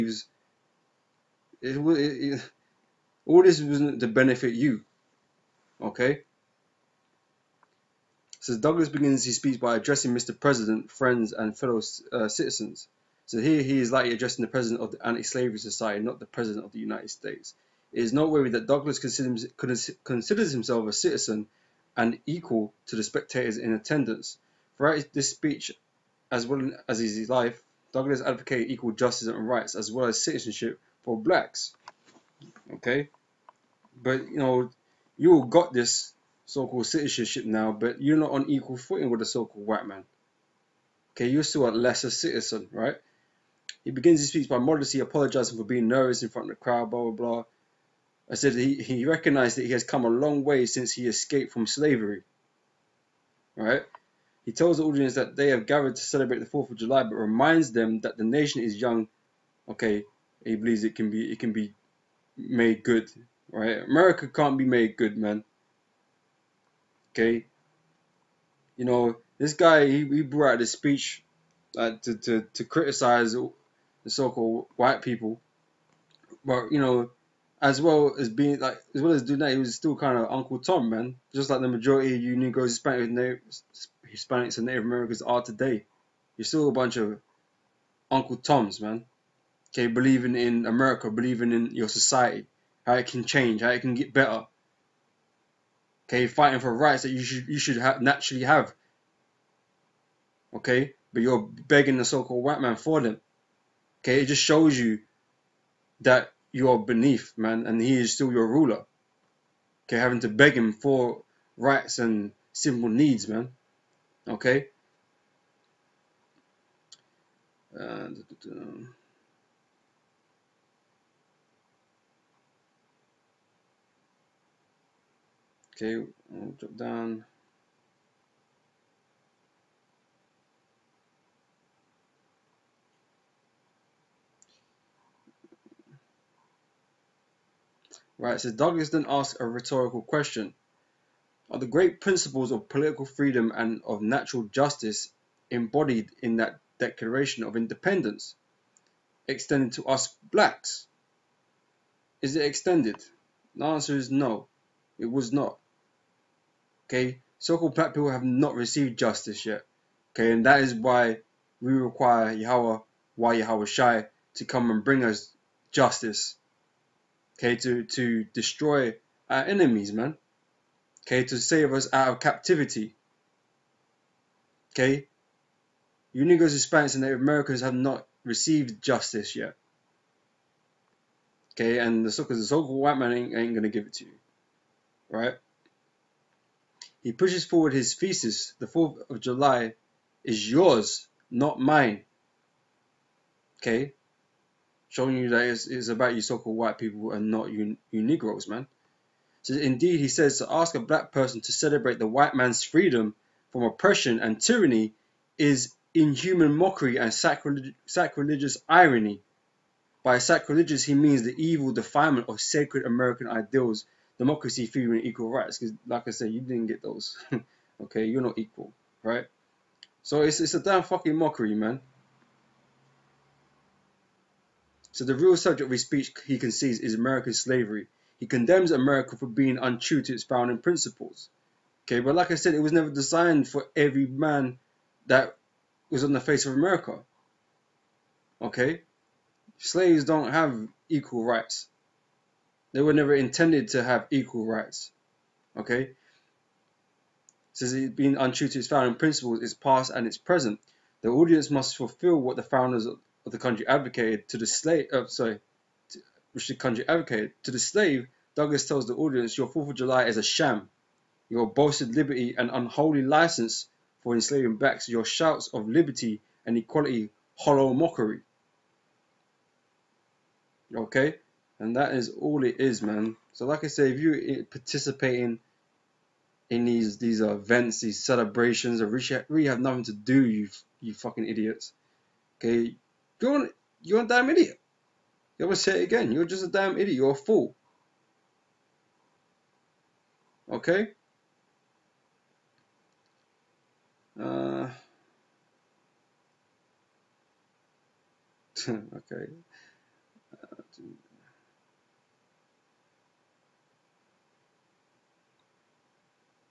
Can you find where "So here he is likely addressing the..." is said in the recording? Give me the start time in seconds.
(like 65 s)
13 s.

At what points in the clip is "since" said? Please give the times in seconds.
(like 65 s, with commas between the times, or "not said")
50 s, 247 s.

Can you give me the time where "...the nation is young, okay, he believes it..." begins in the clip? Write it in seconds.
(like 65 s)
58 s.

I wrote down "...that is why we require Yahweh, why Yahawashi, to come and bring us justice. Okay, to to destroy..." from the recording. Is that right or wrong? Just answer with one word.
right.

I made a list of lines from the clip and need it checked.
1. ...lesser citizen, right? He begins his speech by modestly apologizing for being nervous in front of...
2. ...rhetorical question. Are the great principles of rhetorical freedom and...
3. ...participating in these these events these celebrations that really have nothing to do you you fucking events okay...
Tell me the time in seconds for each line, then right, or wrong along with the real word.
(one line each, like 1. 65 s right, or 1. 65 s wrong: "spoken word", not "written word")
1. 41 s right
2. 139 s wrong: "political", not "rhetorical"
3. 274 s wrong: "idiots", not "events".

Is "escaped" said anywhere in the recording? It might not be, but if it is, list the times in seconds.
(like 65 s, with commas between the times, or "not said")
51 s.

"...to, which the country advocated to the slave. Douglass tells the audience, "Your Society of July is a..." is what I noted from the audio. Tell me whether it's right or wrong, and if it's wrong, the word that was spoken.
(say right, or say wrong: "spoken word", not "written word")
wrong: "Fourth", not "Society".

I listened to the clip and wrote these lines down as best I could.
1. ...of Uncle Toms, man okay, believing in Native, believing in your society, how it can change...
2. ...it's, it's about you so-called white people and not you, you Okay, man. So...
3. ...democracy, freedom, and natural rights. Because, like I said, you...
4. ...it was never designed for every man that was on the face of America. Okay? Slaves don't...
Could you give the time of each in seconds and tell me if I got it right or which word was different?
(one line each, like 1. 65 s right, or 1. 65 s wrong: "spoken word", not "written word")
1. 86 s wrong: "America", not "Native"
2. 195 s wrong: "Negroes", not "Okay"
3. 214 s wrong: "equal", not "natural"
4. 232 s right.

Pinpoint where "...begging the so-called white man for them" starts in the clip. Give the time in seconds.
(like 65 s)
101 s.